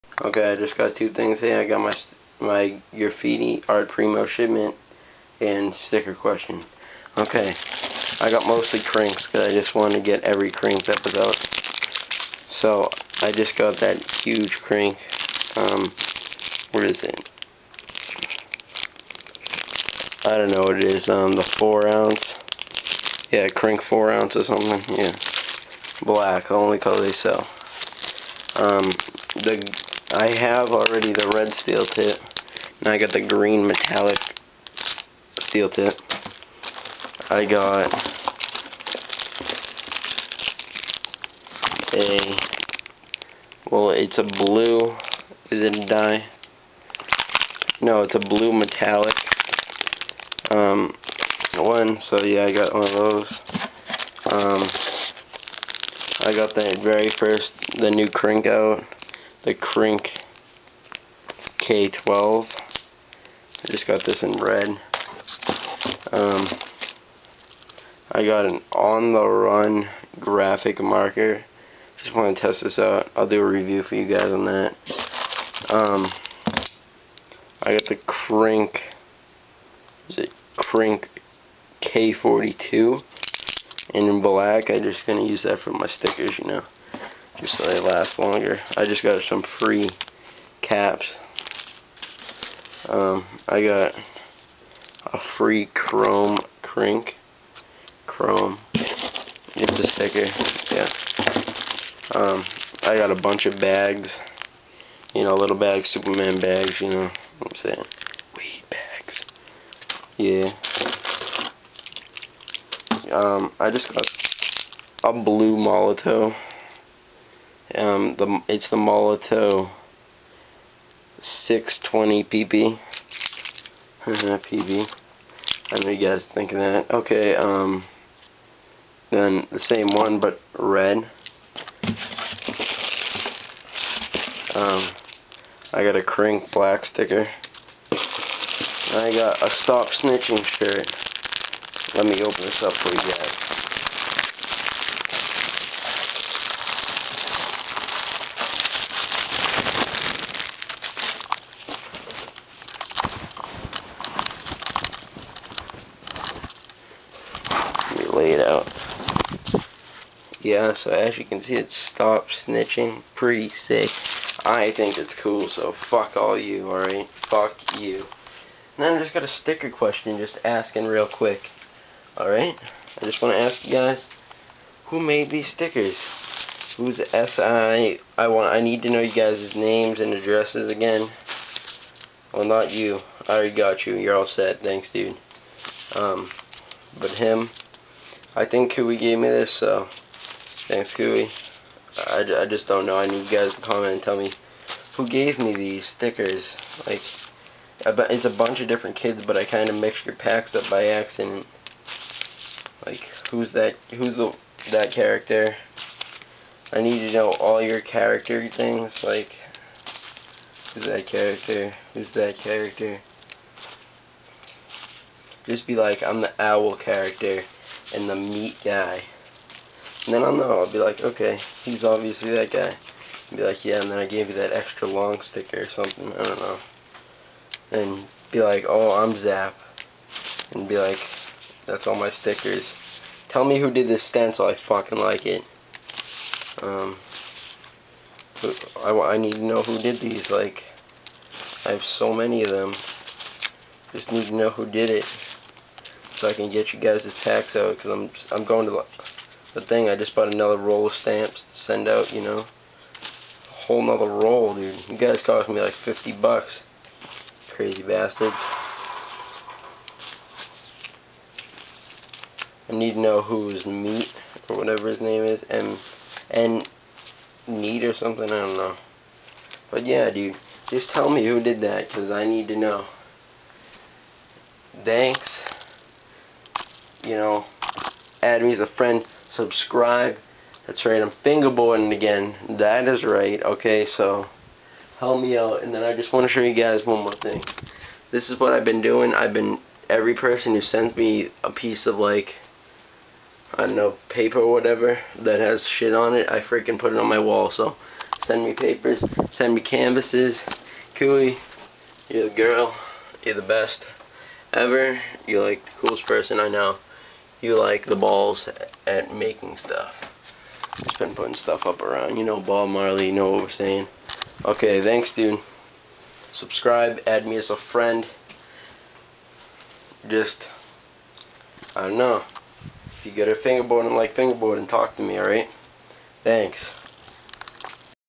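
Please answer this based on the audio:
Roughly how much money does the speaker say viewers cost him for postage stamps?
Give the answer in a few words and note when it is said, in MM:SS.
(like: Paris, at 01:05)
50 bucks, at 04:15.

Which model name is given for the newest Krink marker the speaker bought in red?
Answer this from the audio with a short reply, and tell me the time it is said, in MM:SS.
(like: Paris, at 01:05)
K12, at 01:01.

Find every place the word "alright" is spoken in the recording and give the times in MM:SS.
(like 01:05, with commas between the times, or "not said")
02:46, 02:52, 05:25.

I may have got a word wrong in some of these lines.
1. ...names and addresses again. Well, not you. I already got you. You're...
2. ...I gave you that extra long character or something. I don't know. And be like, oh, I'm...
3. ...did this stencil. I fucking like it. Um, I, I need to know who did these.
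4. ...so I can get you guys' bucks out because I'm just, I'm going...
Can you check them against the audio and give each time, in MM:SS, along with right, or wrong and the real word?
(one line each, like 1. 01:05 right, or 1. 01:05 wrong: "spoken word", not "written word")
1. 02:59 right
2. 03:43 wrong: "sticker", not "character"
3. 03:53 right
4. 04:06 wrong: "packs", not "bucks".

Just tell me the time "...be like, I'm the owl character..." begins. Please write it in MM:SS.
03:35.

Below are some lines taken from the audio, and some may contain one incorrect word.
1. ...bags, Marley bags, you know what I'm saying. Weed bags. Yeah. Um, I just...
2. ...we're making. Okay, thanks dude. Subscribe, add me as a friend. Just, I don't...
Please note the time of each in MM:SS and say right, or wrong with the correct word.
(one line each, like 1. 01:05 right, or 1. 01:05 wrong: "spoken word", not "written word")
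1. 01:45 wrong: "Superman", not "Marley"
2. 05:13 wrong: "saying", not "making".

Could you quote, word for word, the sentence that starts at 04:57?
So send me papers, send me canvases.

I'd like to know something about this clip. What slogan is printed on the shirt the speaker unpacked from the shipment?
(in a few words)
Stop Snitching.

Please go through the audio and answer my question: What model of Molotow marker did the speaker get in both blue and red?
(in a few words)
620 PB.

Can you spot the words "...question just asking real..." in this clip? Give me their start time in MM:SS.
02:49.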